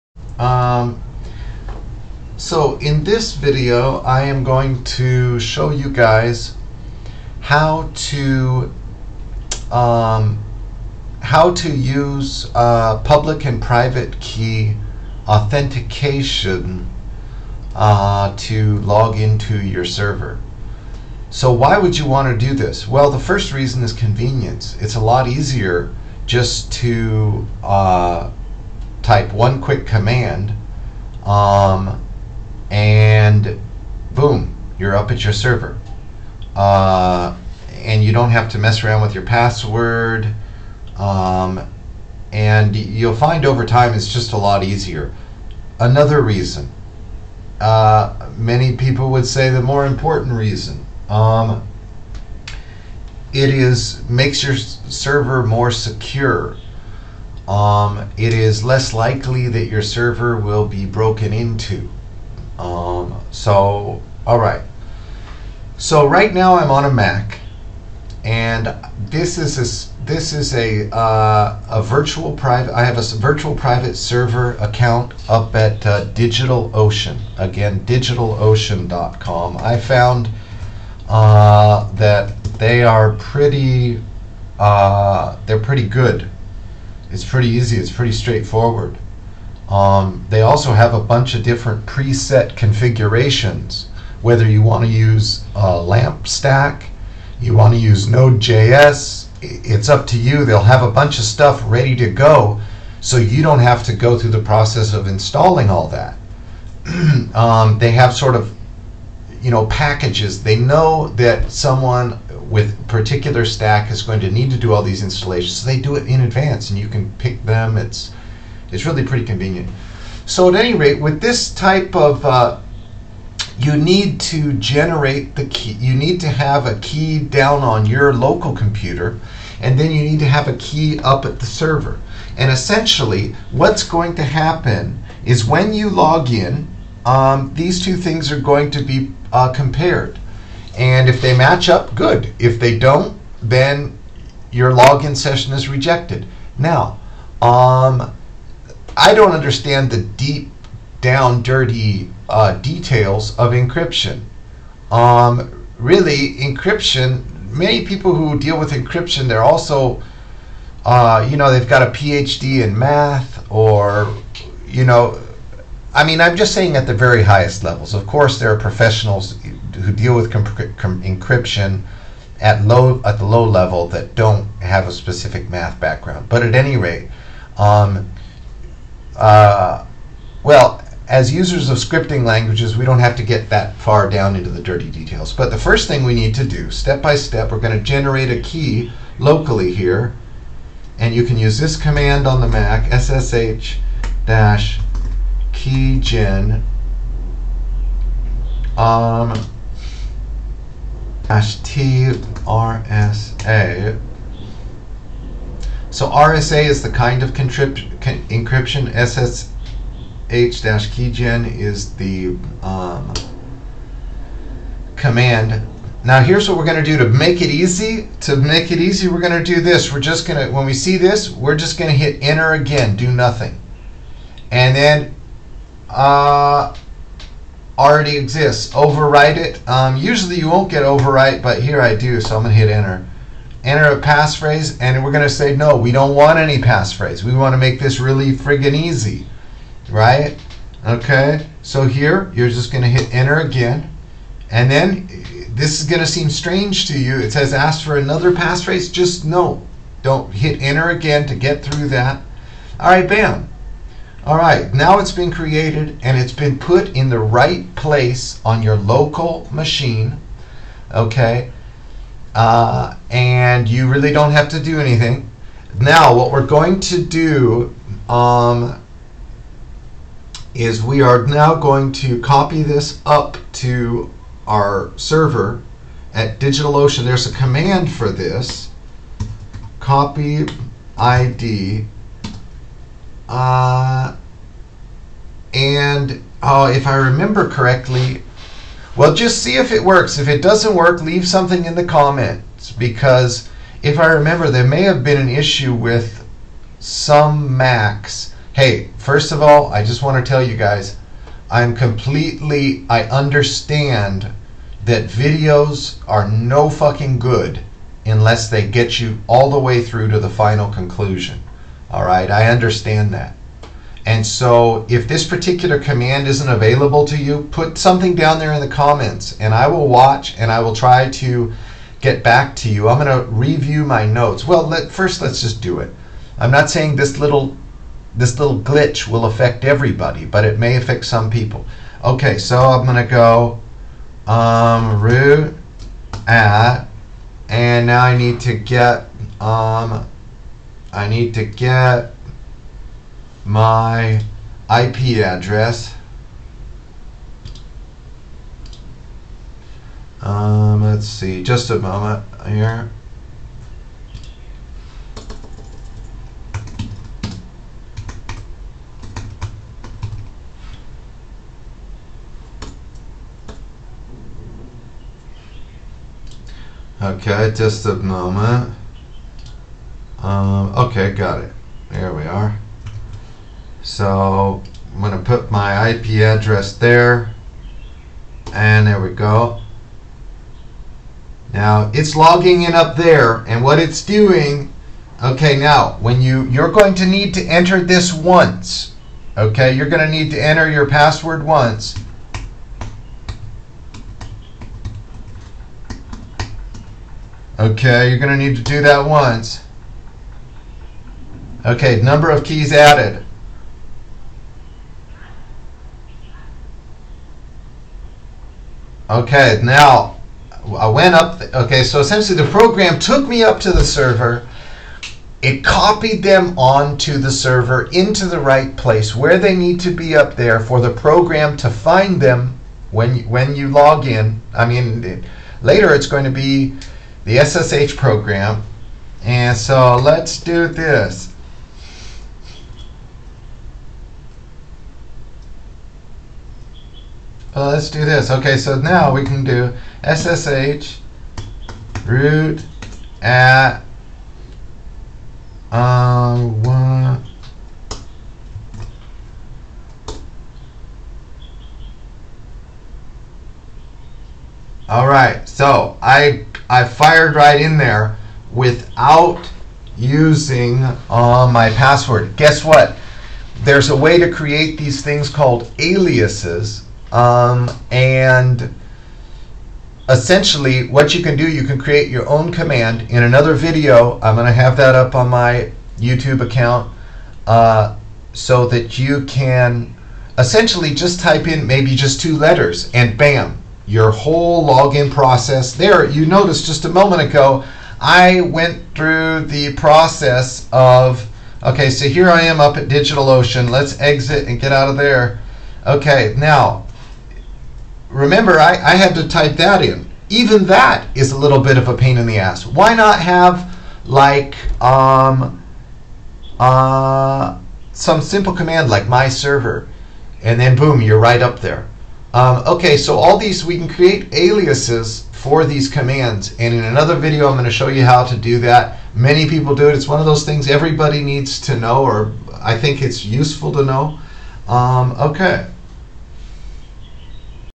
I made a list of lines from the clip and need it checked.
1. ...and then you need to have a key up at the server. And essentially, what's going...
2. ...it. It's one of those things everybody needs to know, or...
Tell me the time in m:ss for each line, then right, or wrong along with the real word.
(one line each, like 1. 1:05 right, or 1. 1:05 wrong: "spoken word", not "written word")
1. 2:09 right
2. 8:39 right.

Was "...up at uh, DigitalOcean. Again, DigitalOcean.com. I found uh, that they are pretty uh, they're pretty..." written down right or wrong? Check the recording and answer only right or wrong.
right.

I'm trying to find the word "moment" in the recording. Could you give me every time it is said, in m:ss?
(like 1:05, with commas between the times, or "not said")
5:51, 6:07, 8:06.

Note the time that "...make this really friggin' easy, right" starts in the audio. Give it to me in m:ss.
3:57.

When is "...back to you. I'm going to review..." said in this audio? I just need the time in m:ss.
5:22.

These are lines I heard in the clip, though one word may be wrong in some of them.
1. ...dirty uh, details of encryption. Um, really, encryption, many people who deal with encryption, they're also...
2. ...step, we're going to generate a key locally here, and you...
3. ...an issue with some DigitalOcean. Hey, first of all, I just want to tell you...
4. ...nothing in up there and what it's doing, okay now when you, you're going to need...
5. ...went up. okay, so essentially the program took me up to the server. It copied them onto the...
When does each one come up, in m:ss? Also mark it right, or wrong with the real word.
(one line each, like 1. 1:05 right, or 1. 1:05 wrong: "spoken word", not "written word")
1. 2:31 right
2. 3:07 right
3. 4:55 wrong: "Macs", not "DigitalOcean"
4. 6:22 wrong: "logging", not "nothing"
5. 6:50 right.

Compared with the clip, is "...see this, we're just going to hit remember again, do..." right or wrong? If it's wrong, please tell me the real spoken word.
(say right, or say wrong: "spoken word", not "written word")
wrong: "enter", not "remember".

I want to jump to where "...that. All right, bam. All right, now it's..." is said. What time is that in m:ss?
4:11.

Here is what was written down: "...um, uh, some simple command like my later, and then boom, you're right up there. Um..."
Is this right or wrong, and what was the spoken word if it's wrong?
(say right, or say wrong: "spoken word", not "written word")
wrong: "server", not "later".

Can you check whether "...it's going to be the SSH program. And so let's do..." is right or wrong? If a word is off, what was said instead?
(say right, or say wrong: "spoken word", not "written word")
right.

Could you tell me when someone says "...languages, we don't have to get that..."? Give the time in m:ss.
3:02.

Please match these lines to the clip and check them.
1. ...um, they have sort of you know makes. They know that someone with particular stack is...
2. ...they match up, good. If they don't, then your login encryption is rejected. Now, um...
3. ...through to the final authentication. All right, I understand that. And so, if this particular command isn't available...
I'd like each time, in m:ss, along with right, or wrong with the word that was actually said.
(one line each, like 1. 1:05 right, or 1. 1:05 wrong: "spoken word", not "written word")
1. 1:47 wrong: "packages", not "makes"
2. 2:21 wrong: "session", not "encryption"
3. 5:09 wrong: "conclusion", not "authentication".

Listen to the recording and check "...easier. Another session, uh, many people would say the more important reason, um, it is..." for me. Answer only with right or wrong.
wrong.